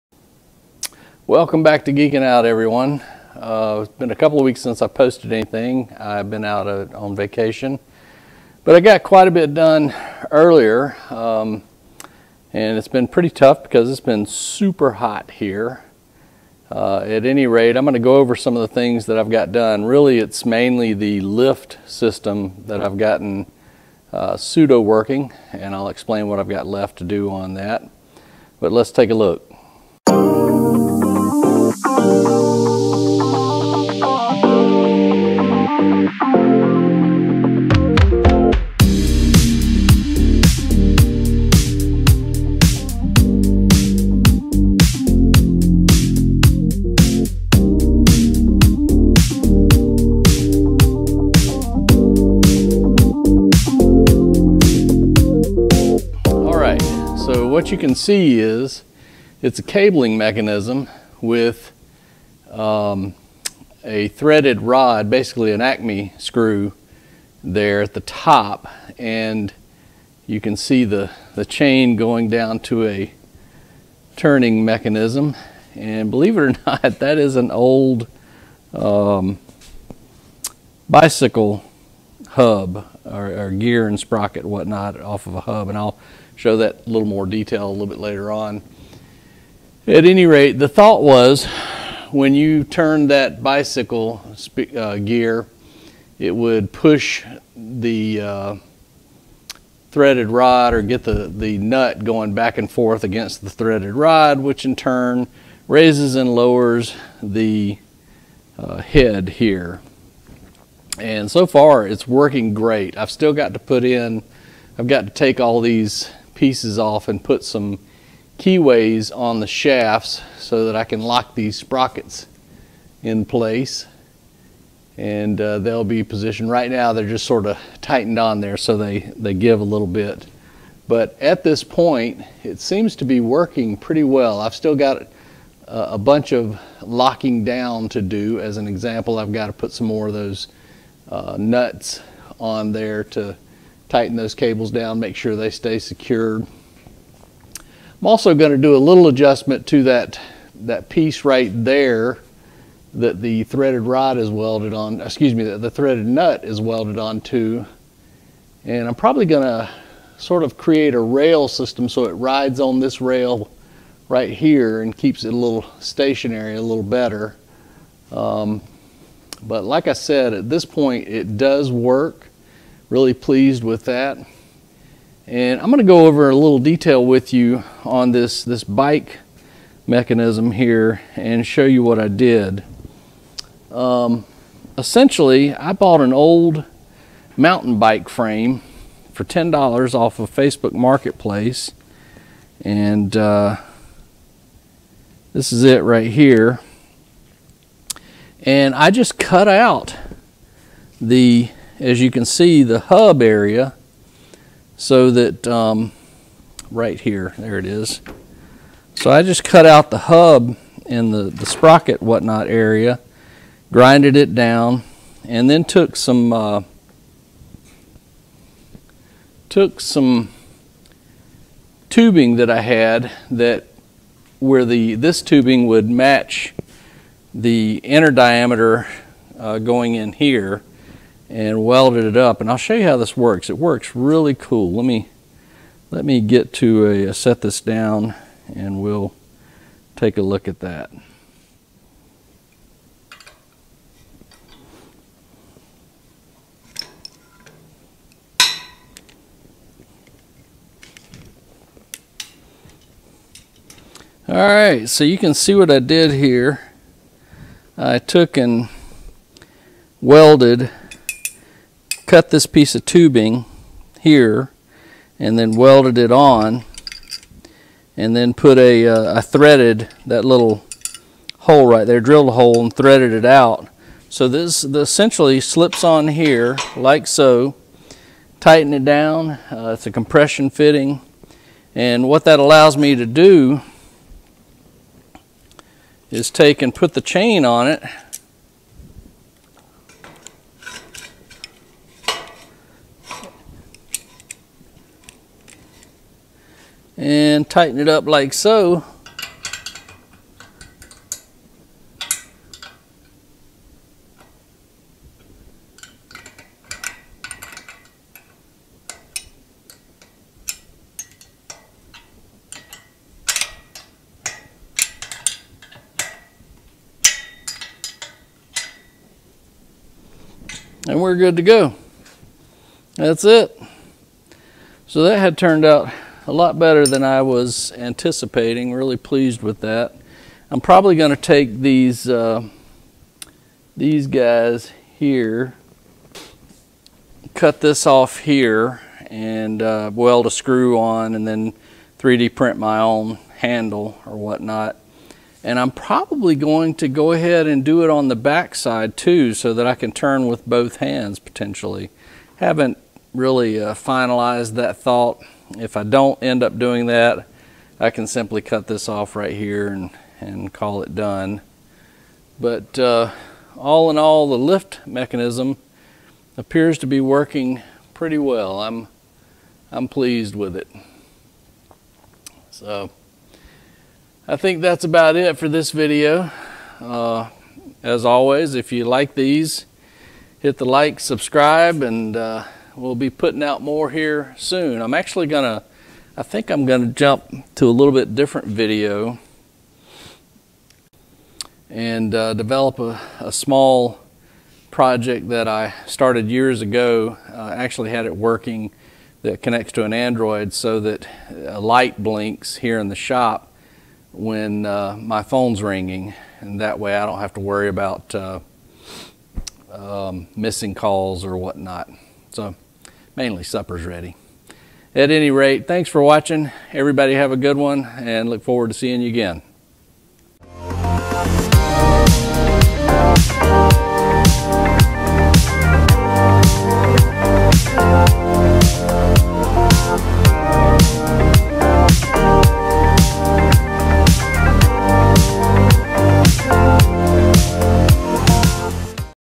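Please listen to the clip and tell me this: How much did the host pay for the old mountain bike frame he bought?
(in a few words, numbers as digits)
$10.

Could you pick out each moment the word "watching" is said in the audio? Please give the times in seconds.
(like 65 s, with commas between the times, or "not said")
416 s.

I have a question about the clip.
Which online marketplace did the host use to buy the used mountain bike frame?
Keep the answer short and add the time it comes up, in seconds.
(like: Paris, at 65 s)
Facebook Marketplace, at 190 s.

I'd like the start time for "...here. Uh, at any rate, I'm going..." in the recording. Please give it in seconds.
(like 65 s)
15 s.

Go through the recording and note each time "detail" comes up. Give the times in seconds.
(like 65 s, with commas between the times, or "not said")
87 s, 176 s.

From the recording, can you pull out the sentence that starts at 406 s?
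And that way I don't have to worry about uh, um, missing calls or whatnot.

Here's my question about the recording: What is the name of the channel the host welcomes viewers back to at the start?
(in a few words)
GeeKenOut.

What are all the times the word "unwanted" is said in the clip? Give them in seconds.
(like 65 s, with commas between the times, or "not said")
not said.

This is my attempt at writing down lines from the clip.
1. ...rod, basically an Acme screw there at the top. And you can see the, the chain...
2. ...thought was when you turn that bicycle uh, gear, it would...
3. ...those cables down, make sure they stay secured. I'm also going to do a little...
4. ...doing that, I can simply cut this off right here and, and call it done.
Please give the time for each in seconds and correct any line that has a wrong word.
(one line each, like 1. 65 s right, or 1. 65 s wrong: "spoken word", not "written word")
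1. 64 s right
2. 90 s right
3. 144 s right
4. 356 s right.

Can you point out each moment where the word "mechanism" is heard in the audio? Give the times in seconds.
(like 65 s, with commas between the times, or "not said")
60 s, 74 s, 179 s, 364 s.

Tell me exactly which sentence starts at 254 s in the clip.
All right, so you can see what I did here.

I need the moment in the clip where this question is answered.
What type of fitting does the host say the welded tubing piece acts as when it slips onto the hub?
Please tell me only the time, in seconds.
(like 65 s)
279 s.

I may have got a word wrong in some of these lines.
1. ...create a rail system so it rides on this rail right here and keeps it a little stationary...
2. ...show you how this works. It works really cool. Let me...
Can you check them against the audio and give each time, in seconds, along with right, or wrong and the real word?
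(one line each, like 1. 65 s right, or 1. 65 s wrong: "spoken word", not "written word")
1. 160 s right
2. 232 s right.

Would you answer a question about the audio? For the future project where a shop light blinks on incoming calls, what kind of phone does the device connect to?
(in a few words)
Android.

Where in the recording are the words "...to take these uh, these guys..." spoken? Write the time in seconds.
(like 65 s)
331 s.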